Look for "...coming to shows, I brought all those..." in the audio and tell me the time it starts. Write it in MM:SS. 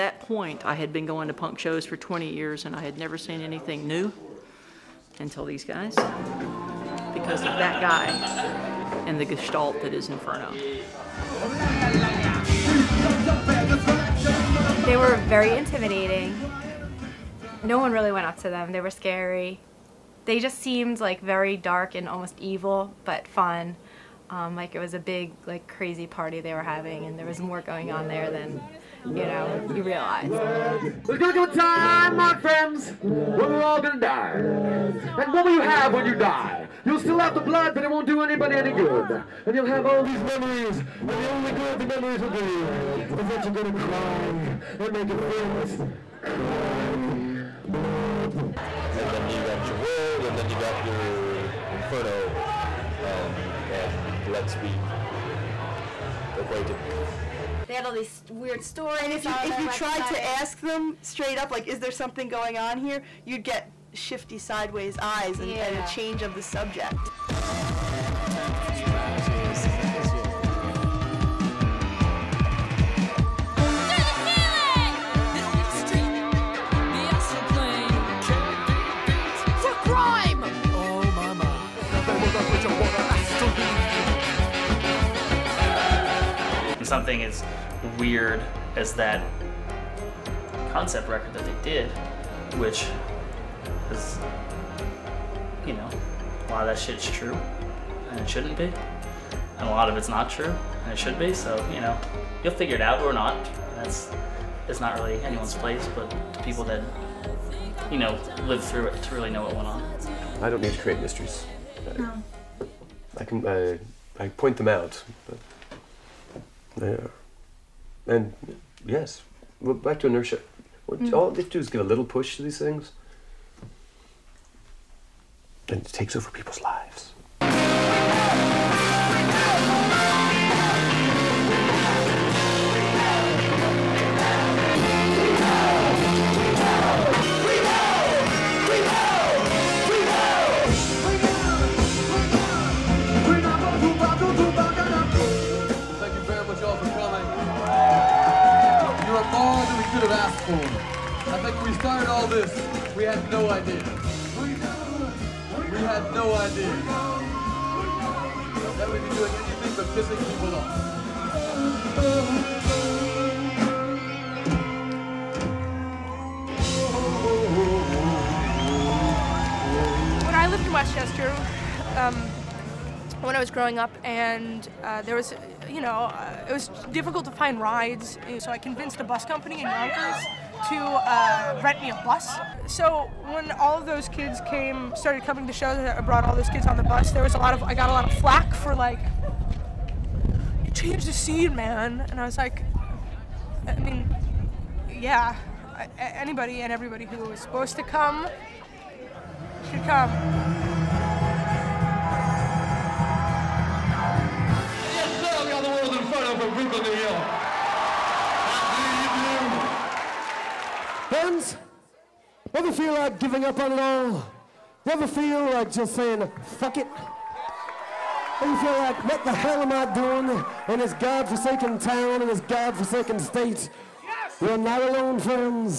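03:05.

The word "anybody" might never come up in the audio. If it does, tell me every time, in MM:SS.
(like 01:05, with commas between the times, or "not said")
00:38, 03:15.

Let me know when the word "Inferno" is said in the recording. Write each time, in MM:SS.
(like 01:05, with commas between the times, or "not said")
00:10, 00:51.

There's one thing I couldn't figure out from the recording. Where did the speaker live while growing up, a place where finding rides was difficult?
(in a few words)
Westchester.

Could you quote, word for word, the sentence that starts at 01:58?
And yes, well, back to inertia.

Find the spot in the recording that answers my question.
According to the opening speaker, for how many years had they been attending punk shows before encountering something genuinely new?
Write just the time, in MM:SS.
00:01.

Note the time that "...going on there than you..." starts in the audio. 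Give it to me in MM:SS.
00:27.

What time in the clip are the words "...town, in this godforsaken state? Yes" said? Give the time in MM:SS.
03:41.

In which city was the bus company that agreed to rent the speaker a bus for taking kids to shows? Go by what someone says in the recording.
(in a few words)
Yonkers.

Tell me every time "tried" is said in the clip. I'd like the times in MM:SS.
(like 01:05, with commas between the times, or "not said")
00:59.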